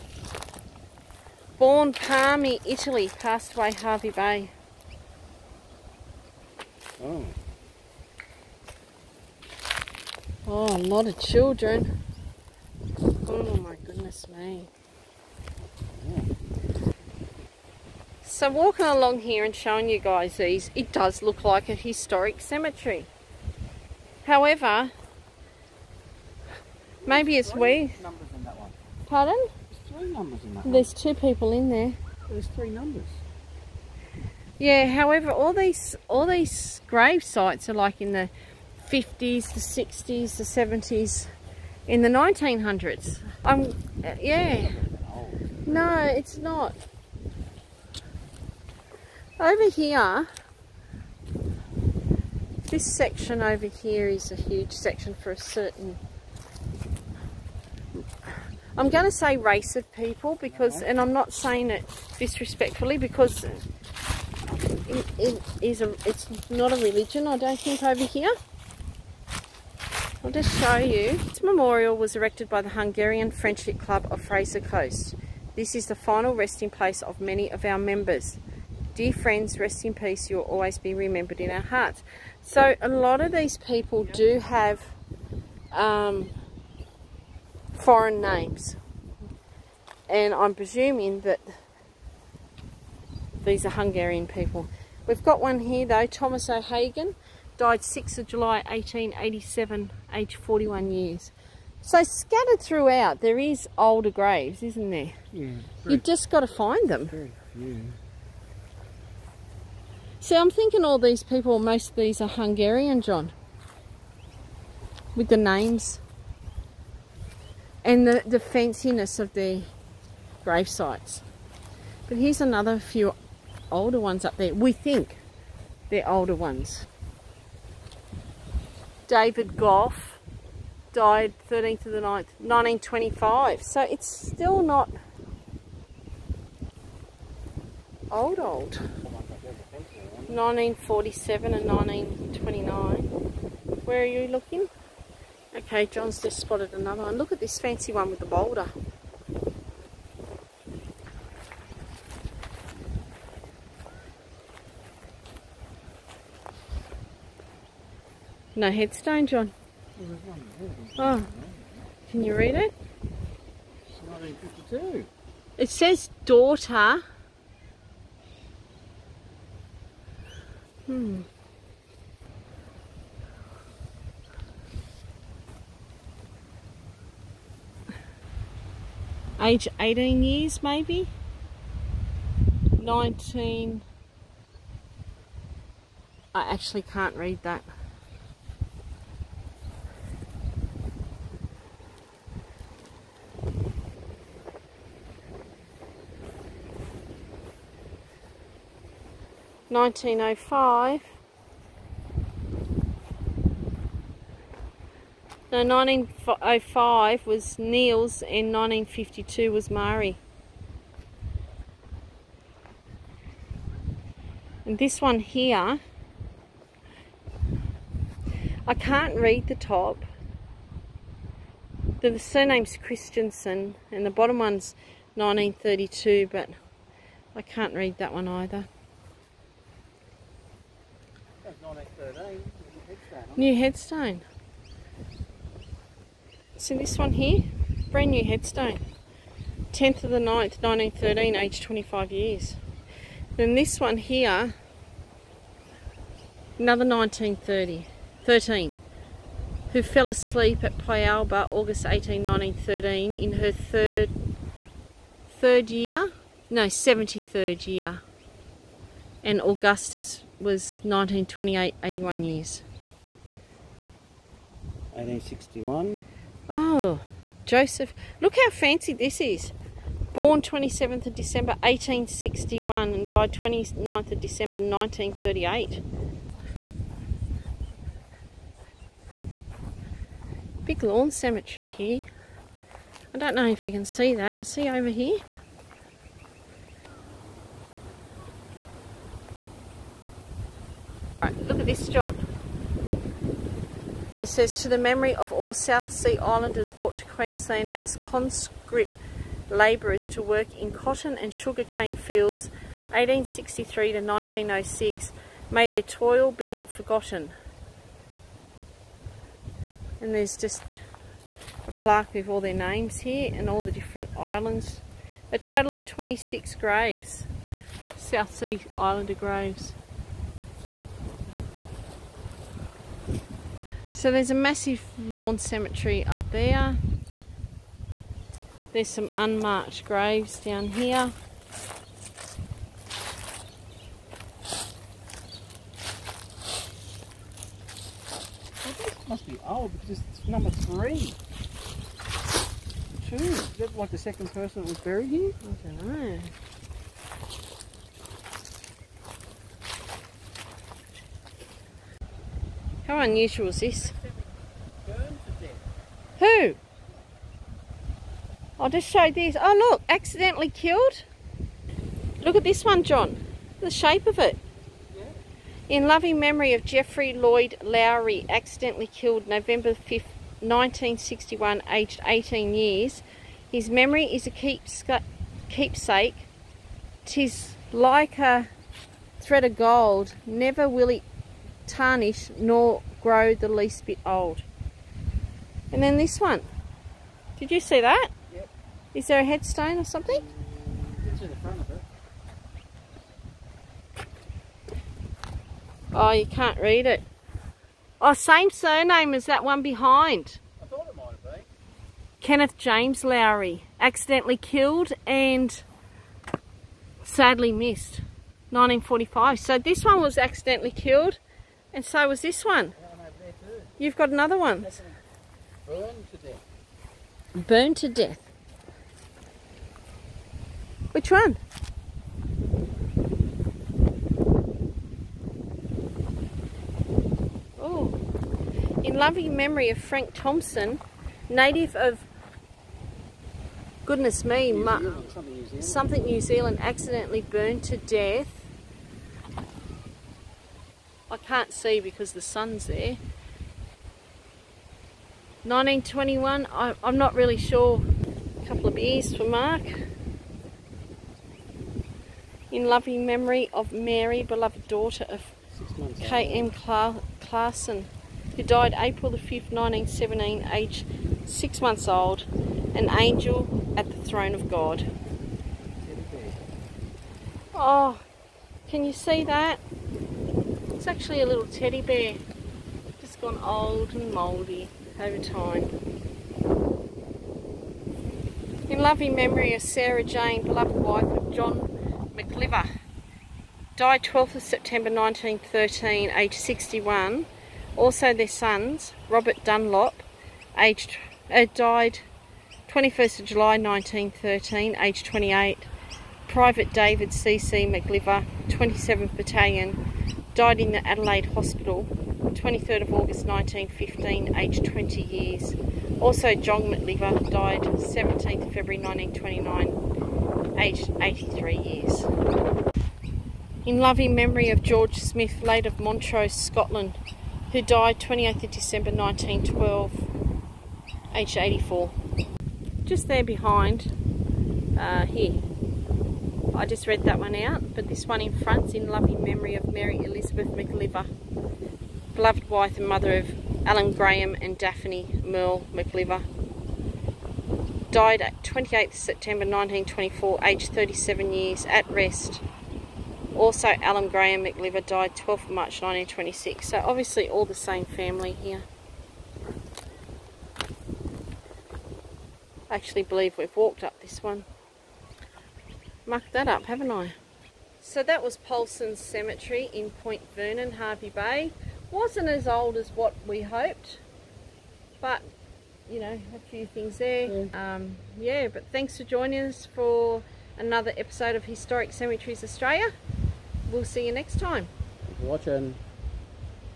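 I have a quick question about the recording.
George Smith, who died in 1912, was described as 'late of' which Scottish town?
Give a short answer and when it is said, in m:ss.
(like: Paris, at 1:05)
Montrose, at 8:35.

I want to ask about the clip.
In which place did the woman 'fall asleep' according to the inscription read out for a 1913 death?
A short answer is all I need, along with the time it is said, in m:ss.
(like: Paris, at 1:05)
Pialba, at 4:10.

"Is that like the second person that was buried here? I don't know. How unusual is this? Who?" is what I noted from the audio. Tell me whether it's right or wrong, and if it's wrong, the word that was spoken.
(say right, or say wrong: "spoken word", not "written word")
right.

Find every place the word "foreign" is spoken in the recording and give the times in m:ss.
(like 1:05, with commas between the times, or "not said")
1:27.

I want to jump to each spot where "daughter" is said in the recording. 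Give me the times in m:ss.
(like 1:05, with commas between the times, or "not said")
2:46, 7:34.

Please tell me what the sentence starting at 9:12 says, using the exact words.
I actually believe we've walked up this one.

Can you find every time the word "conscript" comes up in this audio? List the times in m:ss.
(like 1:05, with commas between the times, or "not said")
4:57.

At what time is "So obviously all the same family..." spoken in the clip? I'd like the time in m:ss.
9:06.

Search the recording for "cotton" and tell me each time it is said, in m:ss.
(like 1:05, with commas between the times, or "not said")
5:00.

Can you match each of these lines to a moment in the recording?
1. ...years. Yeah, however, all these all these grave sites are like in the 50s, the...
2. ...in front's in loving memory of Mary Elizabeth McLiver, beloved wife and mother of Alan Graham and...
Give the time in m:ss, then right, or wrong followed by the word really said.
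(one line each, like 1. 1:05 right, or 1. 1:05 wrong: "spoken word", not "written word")
1. 0:32 wrong: "numbers", not "years"
2. 8:48 right.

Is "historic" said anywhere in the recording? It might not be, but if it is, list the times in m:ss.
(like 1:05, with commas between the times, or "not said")
0:21, 9:31.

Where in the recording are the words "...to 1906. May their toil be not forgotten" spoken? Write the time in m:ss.
5:03.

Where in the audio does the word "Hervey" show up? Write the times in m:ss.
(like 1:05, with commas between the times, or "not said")
0:03, 9:20.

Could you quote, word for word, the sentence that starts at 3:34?
And this one here, I can't read the top.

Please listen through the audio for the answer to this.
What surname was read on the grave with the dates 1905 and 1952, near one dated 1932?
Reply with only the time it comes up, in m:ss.
3:42.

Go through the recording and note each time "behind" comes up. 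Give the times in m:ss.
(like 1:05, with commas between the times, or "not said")
6:39, 8:43.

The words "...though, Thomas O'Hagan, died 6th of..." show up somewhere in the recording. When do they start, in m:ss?
1:35.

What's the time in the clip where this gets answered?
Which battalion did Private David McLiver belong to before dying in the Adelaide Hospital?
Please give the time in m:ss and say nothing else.
8:18.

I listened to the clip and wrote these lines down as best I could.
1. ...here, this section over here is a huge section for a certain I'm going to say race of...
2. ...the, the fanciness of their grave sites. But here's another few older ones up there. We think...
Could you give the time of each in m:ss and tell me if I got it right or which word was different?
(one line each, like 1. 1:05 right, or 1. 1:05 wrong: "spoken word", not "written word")
1. 0:49 right
2. 1:58 right.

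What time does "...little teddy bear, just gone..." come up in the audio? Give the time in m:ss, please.
7:51.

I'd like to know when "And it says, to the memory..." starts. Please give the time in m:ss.
4:54.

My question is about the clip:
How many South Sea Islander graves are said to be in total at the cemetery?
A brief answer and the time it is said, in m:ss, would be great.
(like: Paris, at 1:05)
26, at 5:15.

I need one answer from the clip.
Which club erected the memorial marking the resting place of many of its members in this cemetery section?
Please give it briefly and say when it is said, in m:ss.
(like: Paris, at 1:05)
Hungarian Friendship Club, at 1:12.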